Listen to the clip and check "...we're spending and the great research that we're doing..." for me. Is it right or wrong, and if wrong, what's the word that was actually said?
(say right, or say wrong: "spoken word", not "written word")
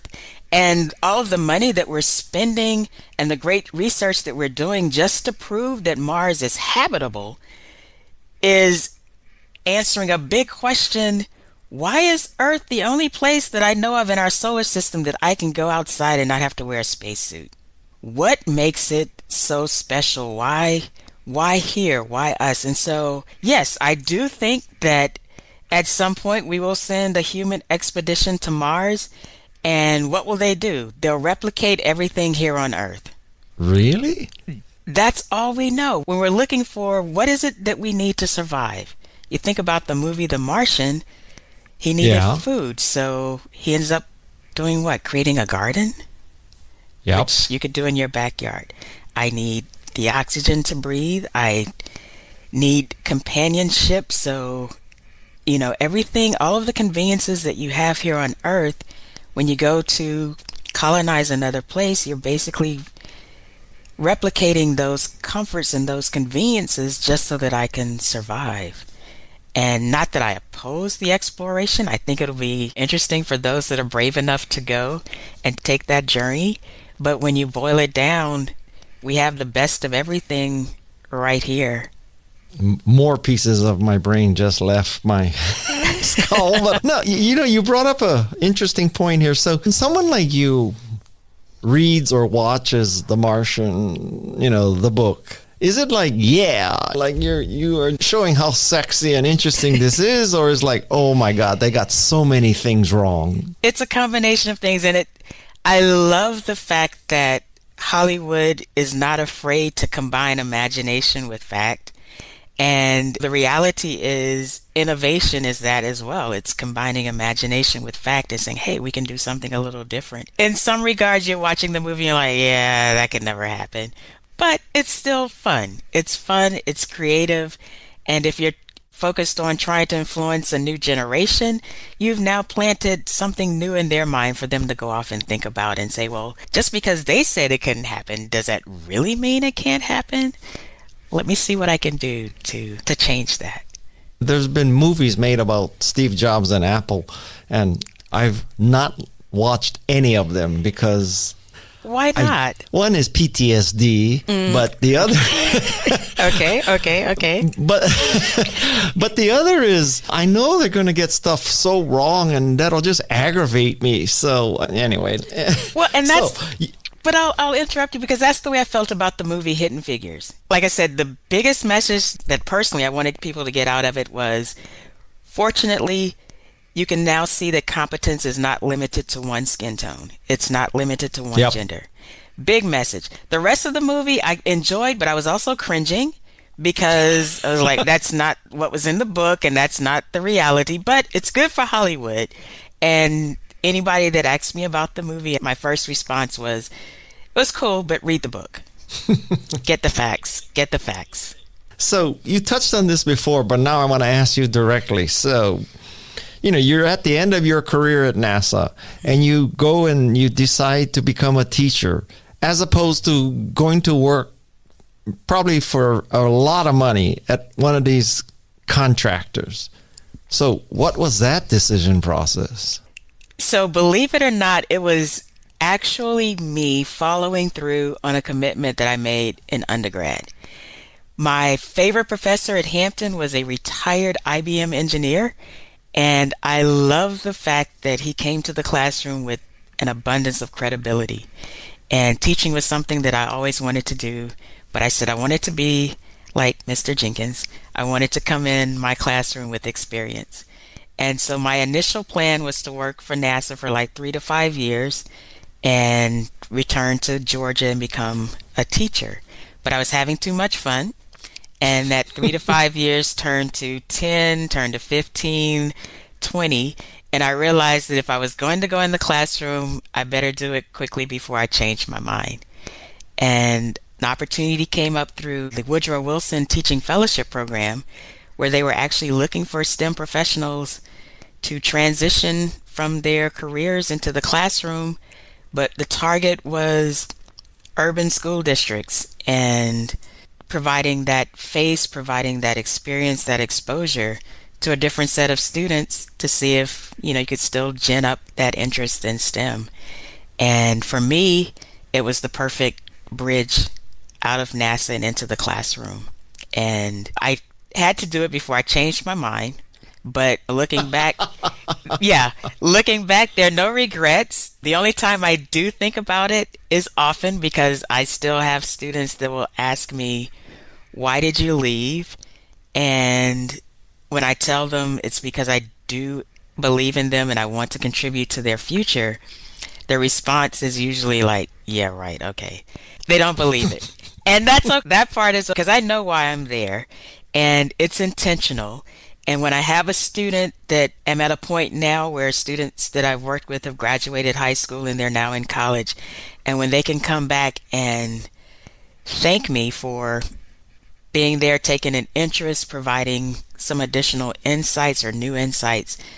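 right.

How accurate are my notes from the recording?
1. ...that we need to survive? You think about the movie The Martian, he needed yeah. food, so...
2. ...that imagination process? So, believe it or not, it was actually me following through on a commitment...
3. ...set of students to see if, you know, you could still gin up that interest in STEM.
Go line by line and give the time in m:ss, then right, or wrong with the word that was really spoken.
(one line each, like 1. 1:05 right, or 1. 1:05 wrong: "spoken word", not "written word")
1. 0:37 right
2. 3:41 wrong: "decision", not "imagination"
3. 4:55 right.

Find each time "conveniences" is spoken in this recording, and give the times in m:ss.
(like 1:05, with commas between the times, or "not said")
0:56, 1:06.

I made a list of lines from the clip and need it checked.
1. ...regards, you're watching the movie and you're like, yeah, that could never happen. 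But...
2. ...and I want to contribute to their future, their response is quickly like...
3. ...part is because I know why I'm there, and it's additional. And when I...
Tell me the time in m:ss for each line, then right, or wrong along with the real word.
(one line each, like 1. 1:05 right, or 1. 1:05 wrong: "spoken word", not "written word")
1. 2:00 right
2. 5:27 wrong: "usually", not "quickly"
3. 5:35 wrong: "intentional", not "additional".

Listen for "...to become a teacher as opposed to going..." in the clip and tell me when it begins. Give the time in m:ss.
3:30.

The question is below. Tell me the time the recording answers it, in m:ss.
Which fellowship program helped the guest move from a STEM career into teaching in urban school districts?
4:35.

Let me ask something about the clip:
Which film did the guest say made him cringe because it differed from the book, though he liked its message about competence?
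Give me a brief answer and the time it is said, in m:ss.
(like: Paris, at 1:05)
Hidden Figures, at 2:49.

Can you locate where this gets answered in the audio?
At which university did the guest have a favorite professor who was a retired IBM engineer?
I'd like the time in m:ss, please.
3:52.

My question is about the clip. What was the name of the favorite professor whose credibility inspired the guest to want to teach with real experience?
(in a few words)
Mr. Jenkins.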